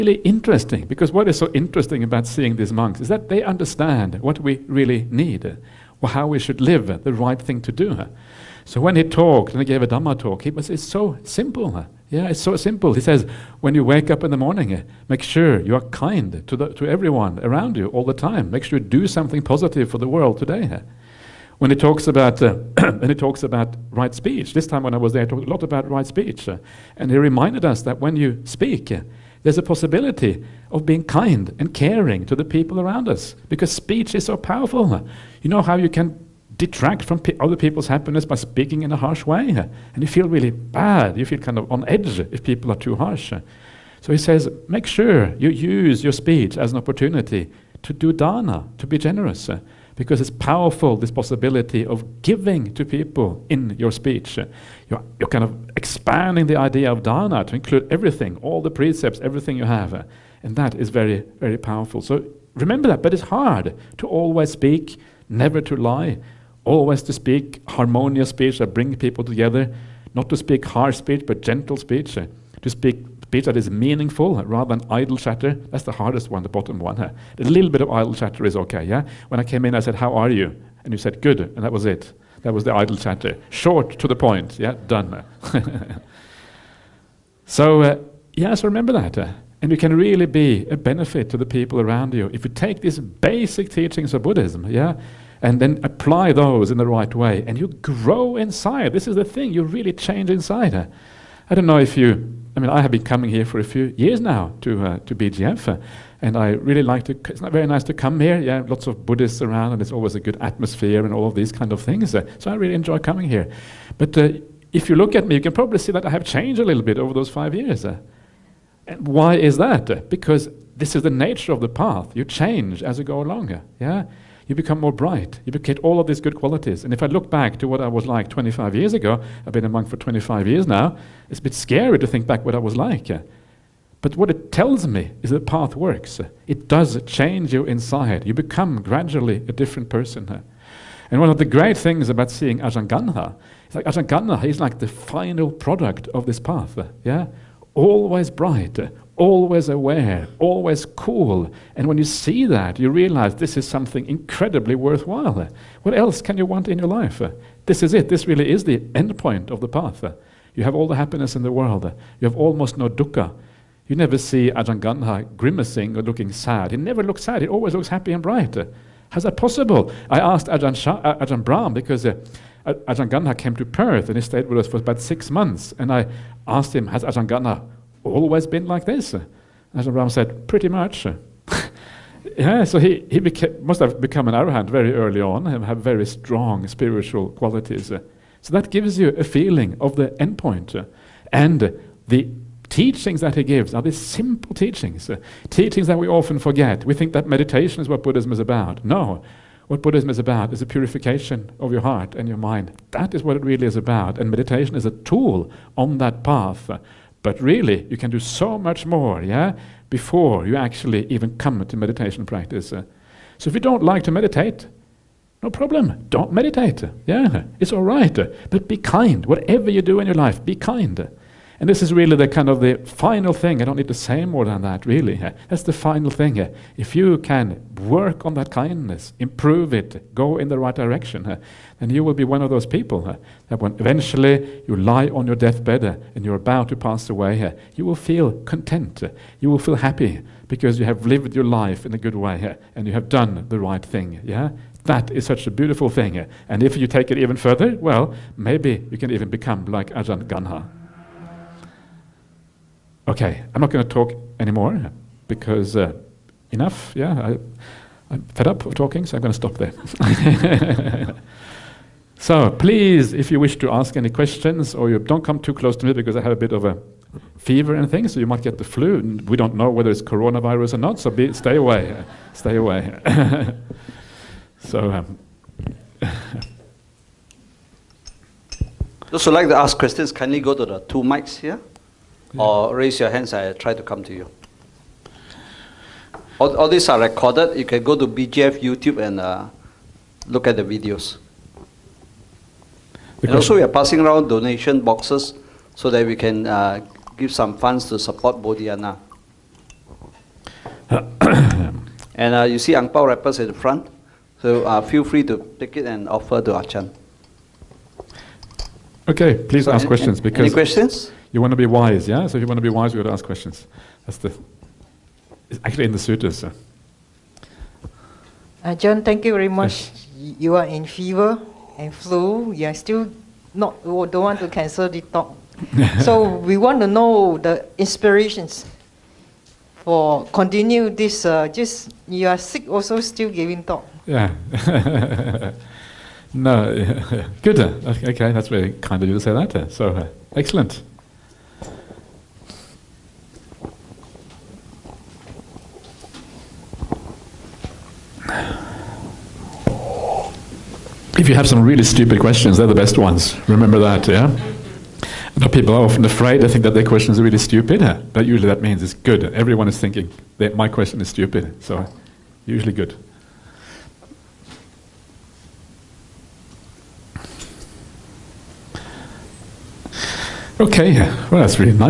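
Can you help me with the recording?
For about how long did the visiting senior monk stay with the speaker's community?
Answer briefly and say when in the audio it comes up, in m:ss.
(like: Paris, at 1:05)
6 months, at 2:55.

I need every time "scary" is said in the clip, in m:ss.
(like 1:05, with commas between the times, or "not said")
2:11.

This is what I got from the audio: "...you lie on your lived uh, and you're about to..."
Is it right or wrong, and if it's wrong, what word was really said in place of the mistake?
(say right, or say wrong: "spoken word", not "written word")
wrong: "deathbed", not "lived".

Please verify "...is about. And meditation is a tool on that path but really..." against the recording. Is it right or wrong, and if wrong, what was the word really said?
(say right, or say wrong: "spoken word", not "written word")
right.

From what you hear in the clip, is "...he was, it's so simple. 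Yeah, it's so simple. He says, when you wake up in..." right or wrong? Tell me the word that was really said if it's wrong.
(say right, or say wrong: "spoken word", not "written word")
right.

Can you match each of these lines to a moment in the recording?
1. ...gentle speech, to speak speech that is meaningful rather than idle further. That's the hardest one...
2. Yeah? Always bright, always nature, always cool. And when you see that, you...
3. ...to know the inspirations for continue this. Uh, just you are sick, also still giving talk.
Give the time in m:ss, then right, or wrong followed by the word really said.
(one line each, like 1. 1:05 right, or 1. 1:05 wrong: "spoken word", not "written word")
1. 1:11 wrong: "chatter", not "further"
2. 2:27 wrong: "aware", not "nature"
3. 5:26 right.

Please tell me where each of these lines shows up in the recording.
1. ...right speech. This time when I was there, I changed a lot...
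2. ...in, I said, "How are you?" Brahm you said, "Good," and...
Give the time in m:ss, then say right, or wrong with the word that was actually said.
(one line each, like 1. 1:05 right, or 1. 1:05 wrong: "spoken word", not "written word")
1. 0:23 wrong: "talked", not "changed"
2. 1:19 wrong: "And", not "Brahm".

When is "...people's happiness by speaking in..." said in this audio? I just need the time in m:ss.
0:37.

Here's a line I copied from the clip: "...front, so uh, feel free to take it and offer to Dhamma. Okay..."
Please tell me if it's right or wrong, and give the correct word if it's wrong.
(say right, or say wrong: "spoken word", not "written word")
wrong: "Ajahn", not "Dhamma".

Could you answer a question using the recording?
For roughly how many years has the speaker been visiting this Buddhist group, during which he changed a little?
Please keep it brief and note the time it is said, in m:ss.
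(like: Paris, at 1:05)
5, at 1:57.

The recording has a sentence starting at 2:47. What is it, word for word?
He always looks happy and bright.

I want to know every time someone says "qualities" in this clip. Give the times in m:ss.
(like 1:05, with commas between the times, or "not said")
2:06, 3:07.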